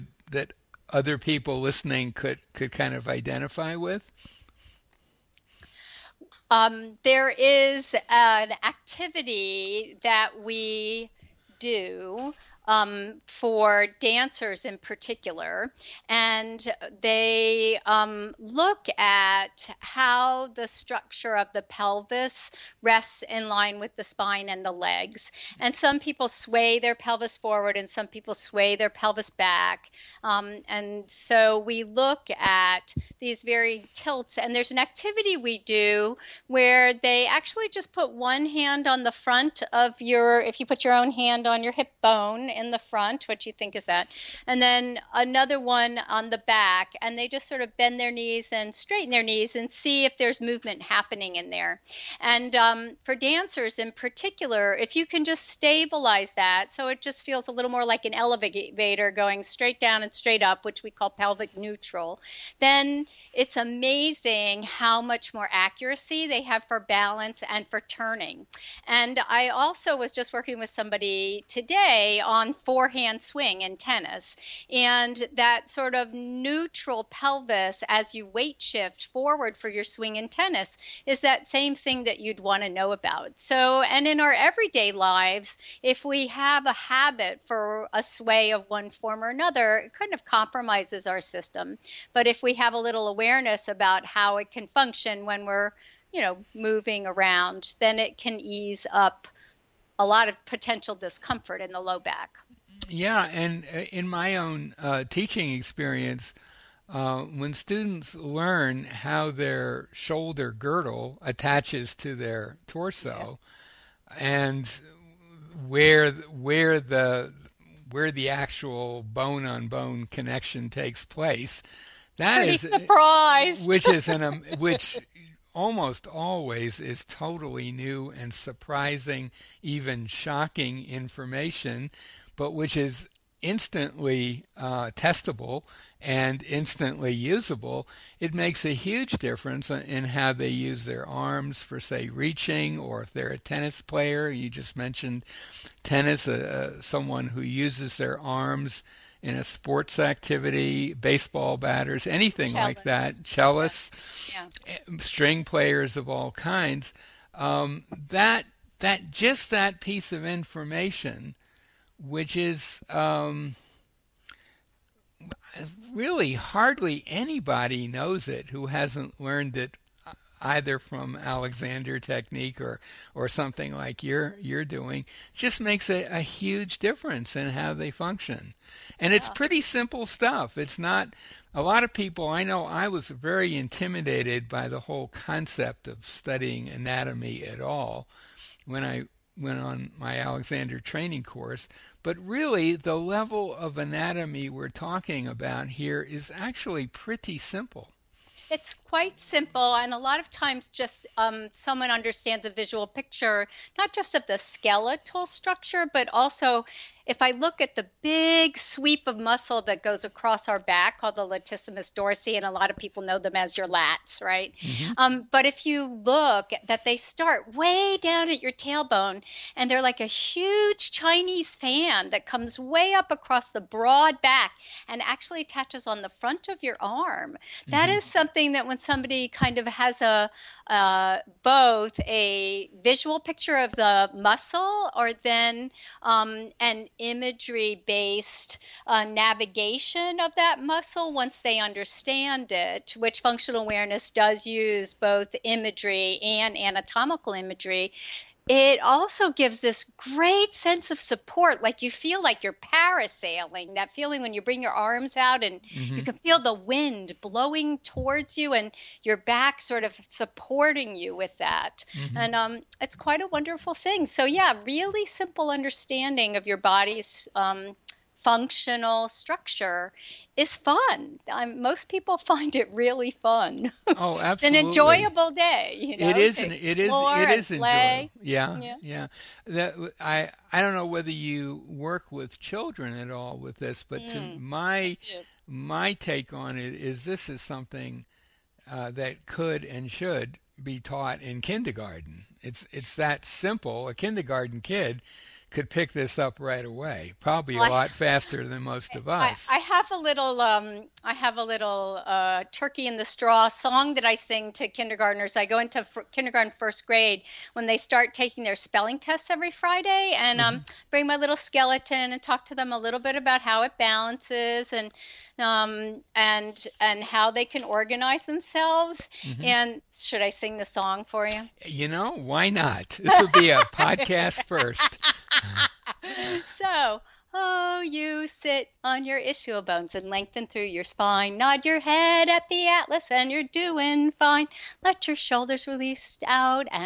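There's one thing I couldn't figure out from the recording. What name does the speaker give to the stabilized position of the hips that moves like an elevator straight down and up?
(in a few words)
pelvic neutral.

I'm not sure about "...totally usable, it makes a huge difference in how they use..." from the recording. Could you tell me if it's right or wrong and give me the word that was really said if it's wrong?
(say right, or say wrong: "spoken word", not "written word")
wrong: "instantly", not "totally".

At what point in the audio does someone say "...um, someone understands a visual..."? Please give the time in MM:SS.
03:21.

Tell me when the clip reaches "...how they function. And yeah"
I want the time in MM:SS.
02:57.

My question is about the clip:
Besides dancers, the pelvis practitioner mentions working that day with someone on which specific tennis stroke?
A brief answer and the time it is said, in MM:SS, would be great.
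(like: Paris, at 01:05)
forehand swing, at 01:12.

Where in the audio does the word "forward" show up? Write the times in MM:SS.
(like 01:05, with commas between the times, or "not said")
00:27, 01:19.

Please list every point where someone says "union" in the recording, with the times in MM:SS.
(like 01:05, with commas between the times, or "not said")
not said.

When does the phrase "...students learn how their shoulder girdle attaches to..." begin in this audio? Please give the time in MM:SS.
01:47.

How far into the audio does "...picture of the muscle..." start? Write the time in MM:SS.
03:53.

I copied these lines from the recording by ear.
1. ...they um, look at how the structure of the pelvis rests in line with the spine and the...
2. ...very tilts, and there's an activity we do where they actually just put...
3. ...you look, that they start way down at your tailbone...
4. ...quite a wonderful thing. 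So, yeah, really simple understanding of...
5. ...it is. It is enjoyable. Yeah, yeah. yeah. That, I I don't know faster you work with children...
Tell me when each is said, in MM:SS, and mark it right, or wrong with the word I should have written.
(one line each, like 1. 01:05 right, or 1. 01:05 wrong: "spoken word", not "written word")
1. 00:16 right
2. 00:33 right
3. 03:35 right
4. 04:22 right
5. 04:36 wrong: "whether", not "faster".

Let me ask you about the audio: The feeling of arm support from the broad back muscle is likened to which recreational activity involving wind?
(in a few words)
parasailing.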